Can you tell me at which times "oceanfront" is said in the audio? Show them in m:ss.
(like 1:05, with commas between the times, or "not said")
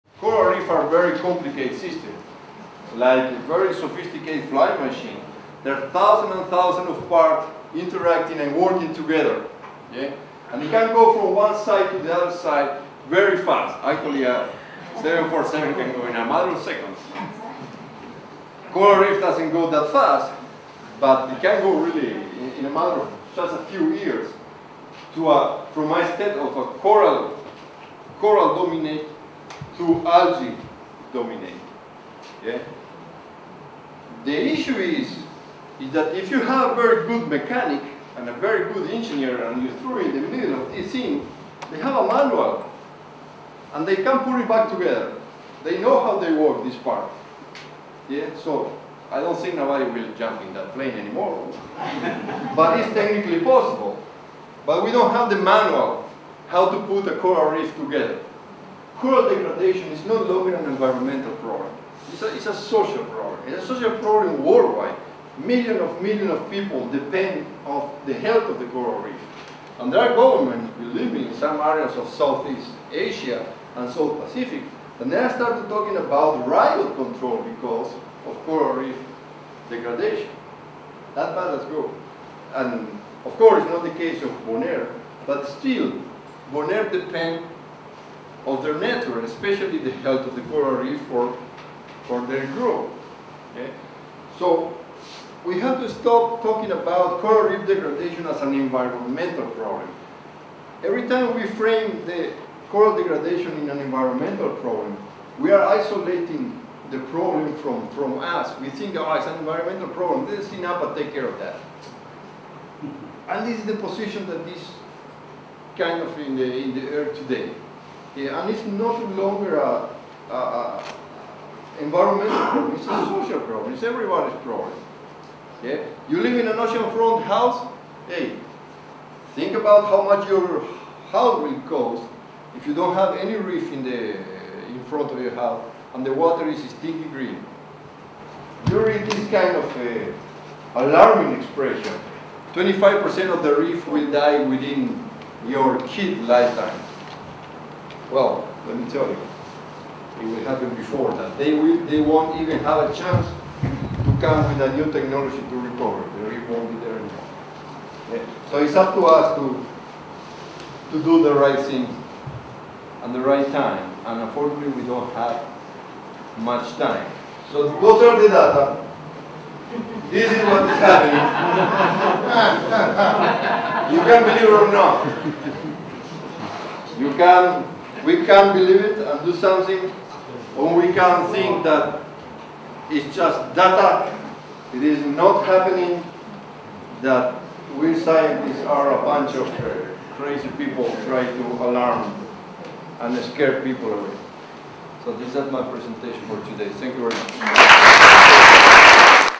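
2:06.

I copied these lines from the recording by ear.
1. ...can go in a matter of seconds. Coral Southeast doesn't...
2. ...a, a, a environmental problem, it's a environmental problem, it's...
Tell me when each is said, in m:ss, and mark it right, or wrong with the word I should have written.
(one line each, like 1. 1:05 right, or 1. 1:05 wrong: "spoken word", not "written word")
1. 0:15 wrong: "Reef", not "Southeast"
2. 1:59 wrong: "social", not "environmental".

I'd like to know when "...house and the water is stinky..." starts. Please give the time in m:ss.
2:15.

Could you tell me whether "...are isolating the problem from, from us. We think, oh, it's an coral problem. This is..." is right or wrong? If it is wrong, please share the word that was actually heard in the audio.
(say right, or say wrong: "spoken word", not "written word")
wrong: "environmental", not "coral".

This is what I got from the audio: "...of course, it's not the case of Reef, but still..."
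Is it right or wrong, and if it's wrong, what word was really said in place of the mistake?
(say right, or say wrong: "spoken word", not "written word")
wrong: "Bonaire", not "Reef".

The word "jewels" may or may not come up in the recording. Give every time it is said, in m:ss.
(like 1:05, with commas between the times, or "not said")
not said.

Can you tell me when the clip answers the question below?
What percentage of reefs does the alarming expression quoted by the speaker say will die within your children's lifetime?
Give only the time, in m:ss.
2:22.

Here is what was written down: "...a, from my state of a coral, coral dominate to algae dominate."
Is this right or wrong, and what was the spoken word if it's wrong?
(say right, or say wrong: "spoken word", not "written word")
right.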